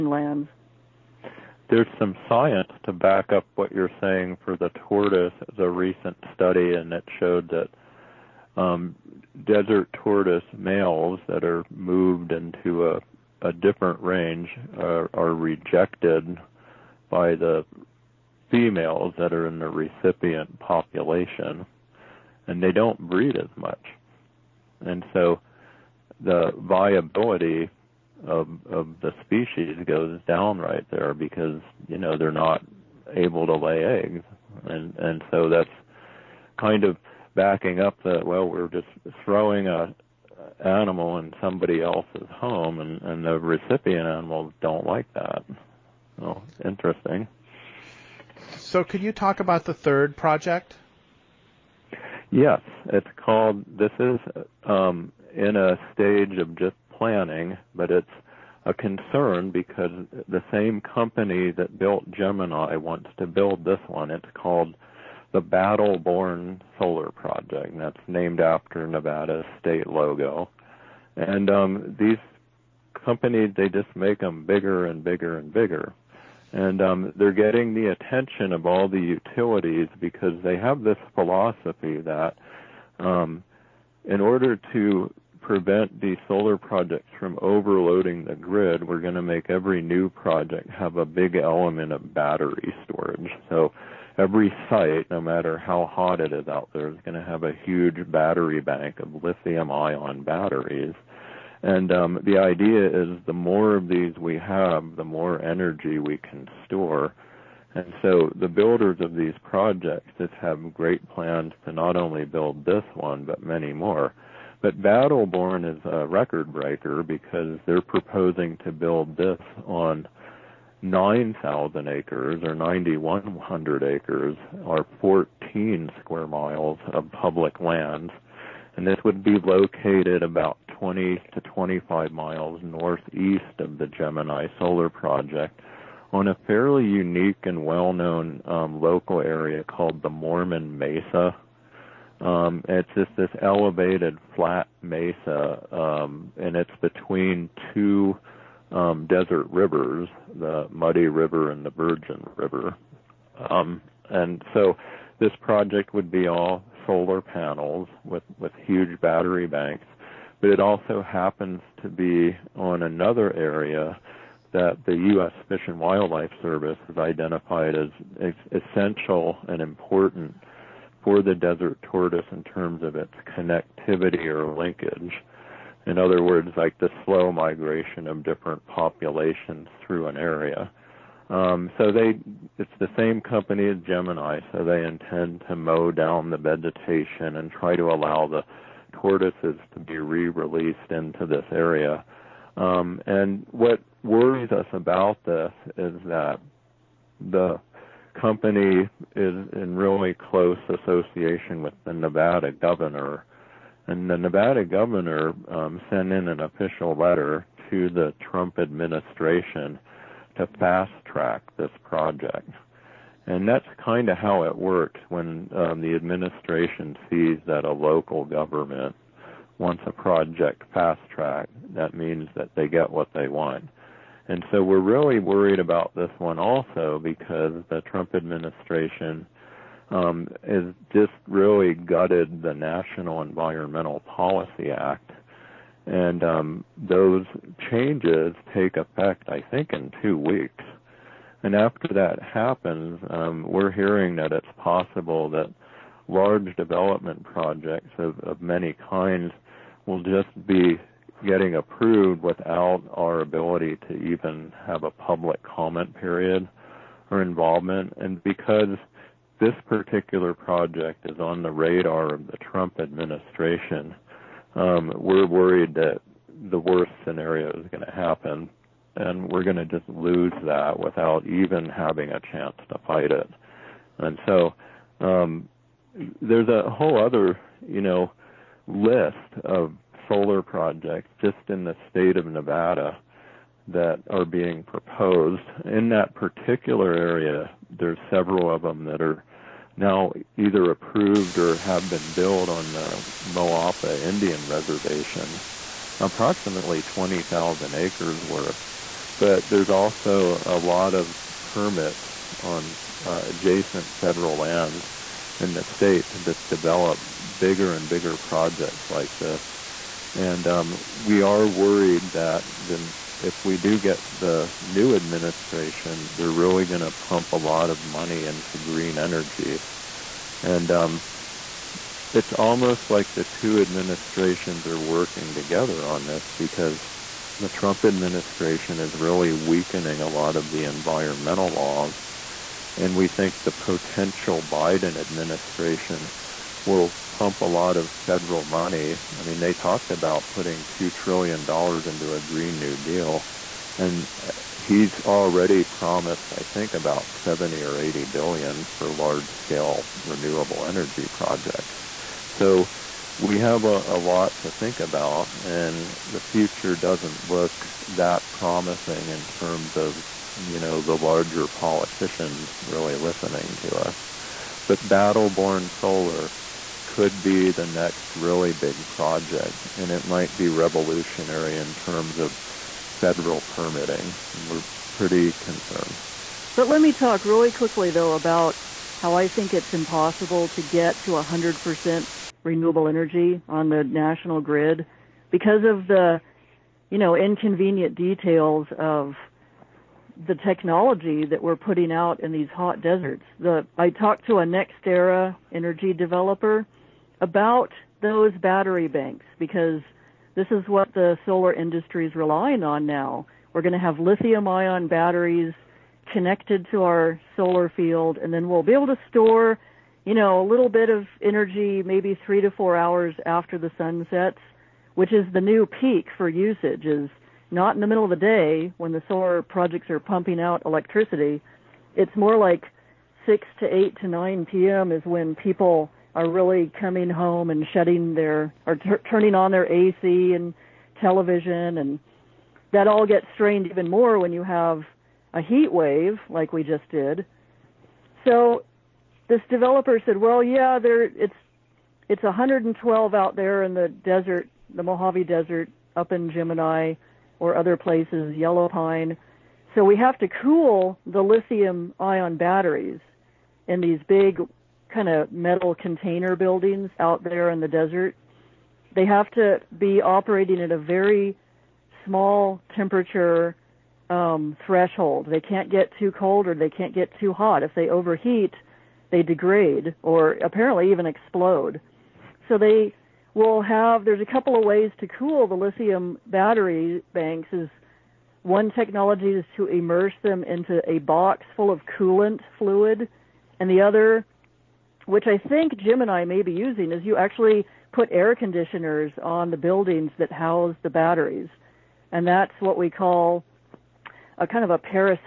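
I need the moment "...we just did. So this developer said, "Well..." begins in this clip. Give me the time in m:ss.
7:16.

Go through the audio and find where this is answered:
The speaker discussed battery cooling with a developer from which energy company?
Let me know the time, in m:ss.
6:34.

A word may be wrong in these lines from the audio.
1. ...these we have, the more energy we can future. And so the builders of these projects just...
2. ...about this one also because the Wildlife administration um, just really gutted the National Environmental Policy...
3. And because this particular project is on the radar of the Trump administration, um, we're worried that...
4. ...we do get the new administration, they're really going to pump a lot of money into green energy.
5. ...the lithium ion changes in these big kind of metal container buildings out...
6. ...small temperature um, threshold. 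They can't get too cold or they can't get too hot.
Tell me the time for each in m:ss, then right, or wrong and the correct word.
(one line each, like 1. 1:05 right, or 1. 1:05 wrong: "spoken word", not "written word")
1. 1:43 wrong: "store", not "future"
2. 3:45 wrong: "Trump", not "Wildlife"
3. 4:17 right
4. 5:13 right
5. 7:31 wrong: "batteries", not "changes"
6. 7:42 right.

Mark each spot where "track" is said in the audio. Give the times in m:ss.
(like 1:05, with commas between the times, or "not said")
3:31, 3:41.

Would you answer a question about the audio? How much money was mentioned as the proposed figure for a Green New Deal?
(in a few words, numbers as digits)
$2 trillion.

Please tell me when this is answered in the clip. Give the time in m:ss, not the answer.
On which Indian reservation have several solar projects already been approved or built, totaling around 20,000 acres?
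4:53.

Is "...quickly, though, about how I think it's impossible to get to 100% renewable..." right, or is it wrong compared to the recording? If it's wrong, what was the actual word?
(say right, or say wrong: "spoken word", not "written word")
right.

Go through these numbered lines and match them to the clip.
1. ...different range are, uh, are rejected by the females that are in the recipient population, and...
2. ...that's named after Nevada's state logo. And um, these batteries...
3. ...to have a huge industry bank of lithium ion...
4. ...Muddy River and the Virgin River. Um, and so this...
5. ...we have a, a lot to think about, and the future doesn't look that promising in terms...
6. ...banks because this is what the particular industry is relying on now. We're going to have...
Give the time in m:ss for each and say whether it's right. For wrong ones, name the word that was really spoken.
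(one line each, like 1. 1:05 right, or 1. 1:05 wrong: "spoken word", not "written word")
1. 0:13 right
2. 1:07 wrong: "companies", not "batteries"
3. 1:37 wrong: "battery", not "industry"
4. 2:30 right
5. 5:53 right
6. 6:38 wrong: "solar", not "particular".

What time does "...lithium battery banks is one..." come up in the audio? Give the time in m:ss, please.
7:55.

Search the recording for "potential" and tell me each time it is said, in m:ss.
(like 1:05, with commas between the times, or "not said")
5:33.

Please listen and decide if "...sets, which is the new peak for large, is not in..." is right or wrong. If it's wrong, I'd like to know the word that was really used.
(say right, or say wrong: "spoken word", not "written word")
wrong: "usage", not "large".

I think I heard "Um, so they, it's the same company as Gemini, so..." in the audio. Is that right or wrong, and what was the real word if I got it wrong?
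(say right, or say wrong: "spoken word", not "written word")
right.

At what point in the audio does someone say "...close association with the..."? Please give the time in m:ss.
3:20.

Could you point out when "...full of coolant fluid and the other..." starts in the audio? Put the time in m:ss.
8:01.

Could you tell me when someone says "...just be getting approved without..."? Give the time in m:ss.
4:10.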